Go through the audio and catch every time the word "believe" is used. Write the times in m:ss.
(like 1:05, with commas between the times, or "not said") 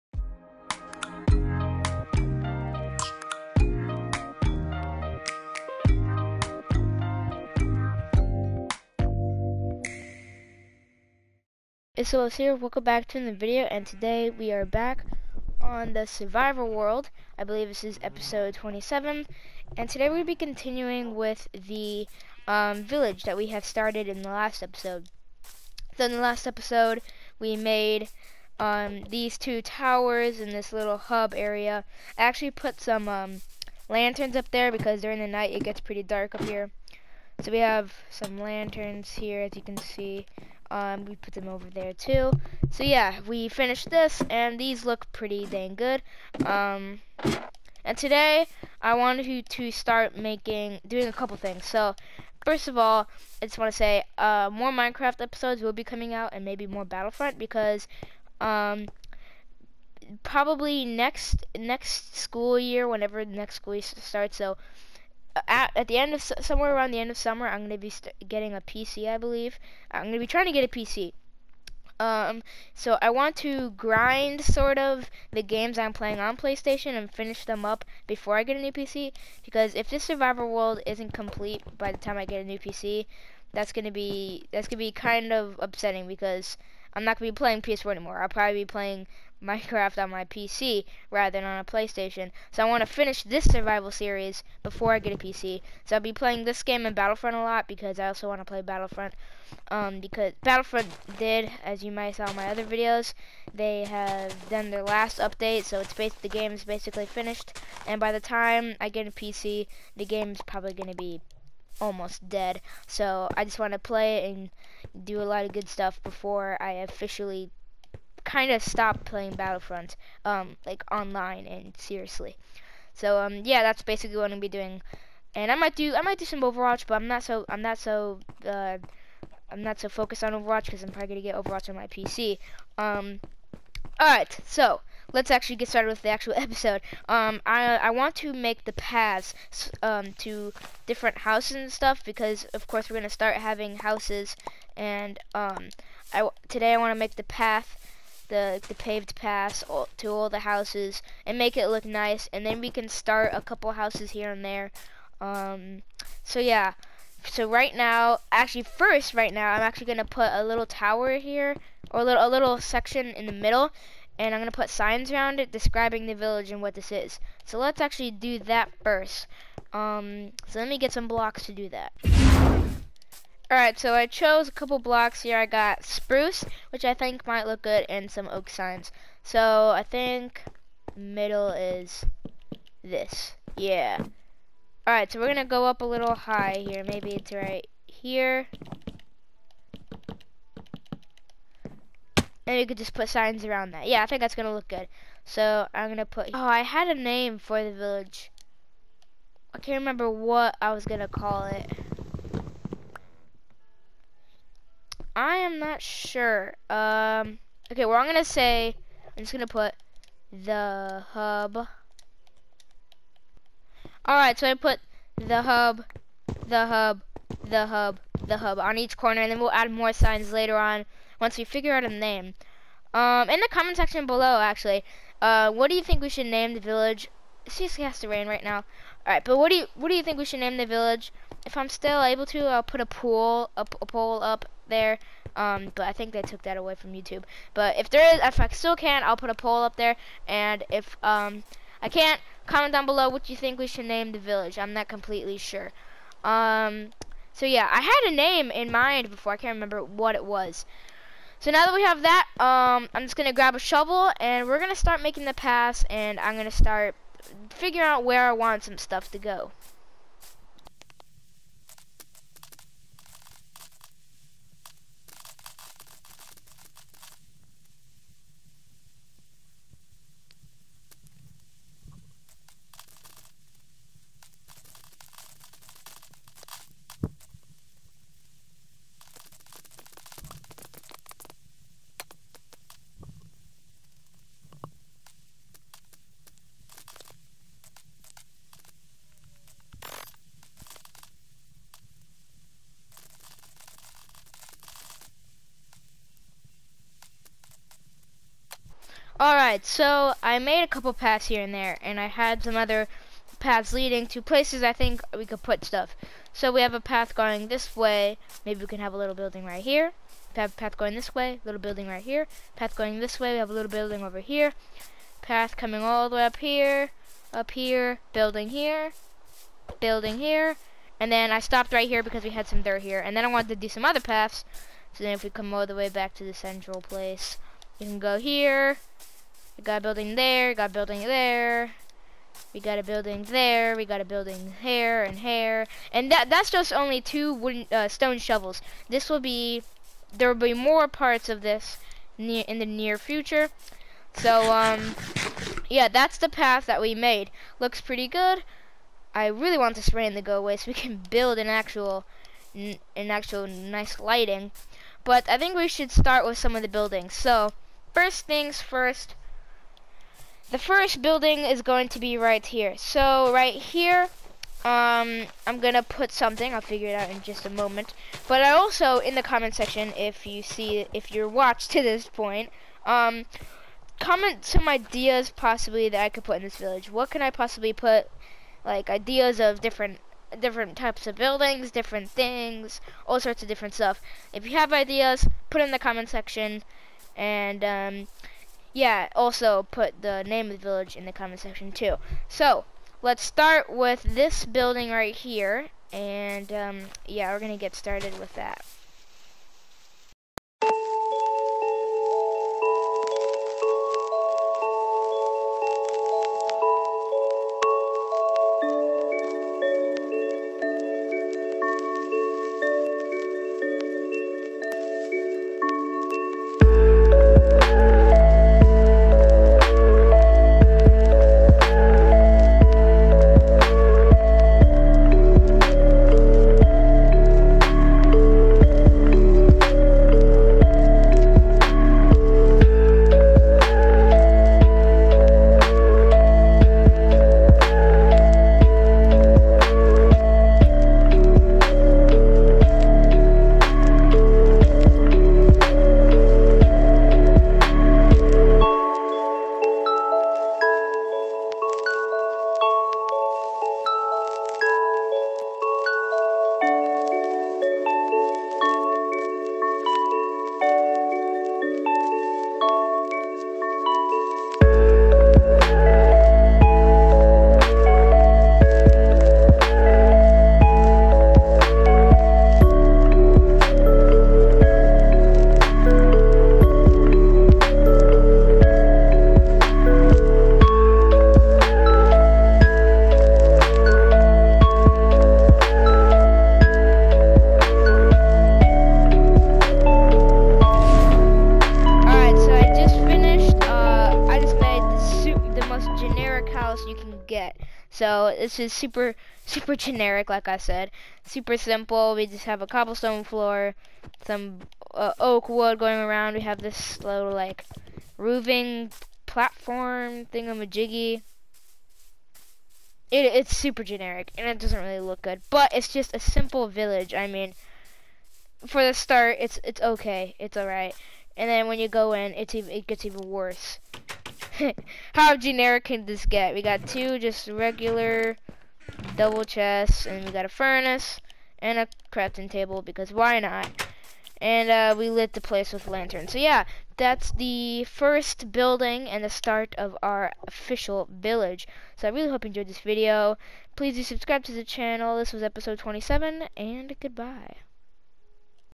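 0:17, 1:09.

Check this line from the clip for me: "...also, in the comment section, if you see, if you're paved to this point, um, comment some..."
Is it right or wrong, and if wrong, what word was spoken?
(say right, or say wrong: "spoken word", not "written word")
wrong: "watched", not "paved".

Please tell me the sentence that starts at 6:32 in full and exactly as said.
So, let's start with this building right here.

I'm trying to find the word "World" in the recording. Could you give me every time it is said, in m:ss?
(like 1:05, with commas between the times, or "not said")
0:16, 1:20.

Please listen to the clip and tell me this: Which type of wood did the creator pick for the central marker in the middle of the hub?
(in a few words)
Spruce.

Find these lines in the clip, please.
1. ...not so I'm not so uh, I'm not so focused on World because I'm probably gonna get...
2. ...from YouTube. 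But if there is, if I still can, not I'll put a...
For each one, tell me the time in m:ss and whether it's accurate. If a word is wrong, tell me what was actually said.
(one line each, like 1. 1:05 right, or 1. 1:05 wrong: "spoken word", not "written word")
1. 2:07 wrong: "Overwatch", not "World"
2. 3:56 right.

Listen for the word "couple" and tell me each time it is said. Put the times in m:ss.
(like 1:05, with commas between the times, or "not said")
0:51, 2:33, 2:54, 5:00.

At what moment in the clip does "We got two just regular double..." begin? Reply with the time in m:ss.
8:46.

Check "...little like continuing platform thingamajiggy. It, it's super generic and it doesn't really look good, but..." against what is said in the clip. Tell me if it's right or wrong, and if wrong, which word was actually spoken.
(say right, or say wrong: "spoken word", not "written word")
wrong: "roofing", not "continuing".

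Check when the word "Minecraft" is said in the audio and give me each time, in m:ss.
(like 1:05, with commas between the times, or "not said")
0:54, 1:29.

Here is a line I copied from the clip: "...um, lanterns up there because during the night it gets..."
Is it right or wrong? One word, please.
right.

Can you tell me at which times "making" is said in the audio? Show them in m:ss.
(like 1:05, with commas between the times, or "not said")
0:50, 4:15.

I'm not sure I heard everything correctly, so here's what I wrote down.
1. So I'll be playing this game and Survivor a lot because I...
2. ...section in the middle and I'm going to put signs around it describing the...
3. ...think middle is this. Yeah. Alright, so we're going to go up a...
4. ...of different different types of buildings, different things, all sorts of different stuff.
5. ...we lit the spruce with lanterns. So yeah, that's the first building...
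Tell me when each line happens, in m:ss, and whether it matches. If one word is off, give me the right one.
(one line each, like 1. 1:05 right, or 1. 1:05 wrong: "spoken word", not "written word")
1. 1:35 wrong: "Battlefront", not "Survivor"
2. 2:42 right
3. 2:59 right
4. 6:19 right
5. 8:54 wrong: "place", not "spruce".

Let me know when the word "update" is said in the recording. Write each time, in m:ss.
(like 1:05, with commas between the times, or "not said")
1:45.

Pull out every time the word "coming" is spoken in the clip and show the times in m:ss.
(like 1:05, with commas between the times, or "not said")
0:55, 5:15.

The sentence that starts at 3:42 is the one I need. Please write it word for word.
Um, in the comment section below, actually, uh, what do you think we should name the village?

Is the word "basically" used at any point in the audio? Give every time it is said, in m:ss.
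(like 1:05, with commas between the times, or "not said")
1:46, 2:03.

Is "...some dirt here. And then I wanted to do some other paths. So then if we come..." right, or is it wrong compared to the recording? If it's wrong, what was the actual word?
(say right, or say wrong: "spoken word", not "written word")
right.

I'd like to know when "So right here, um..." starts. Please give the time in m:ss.
6:02.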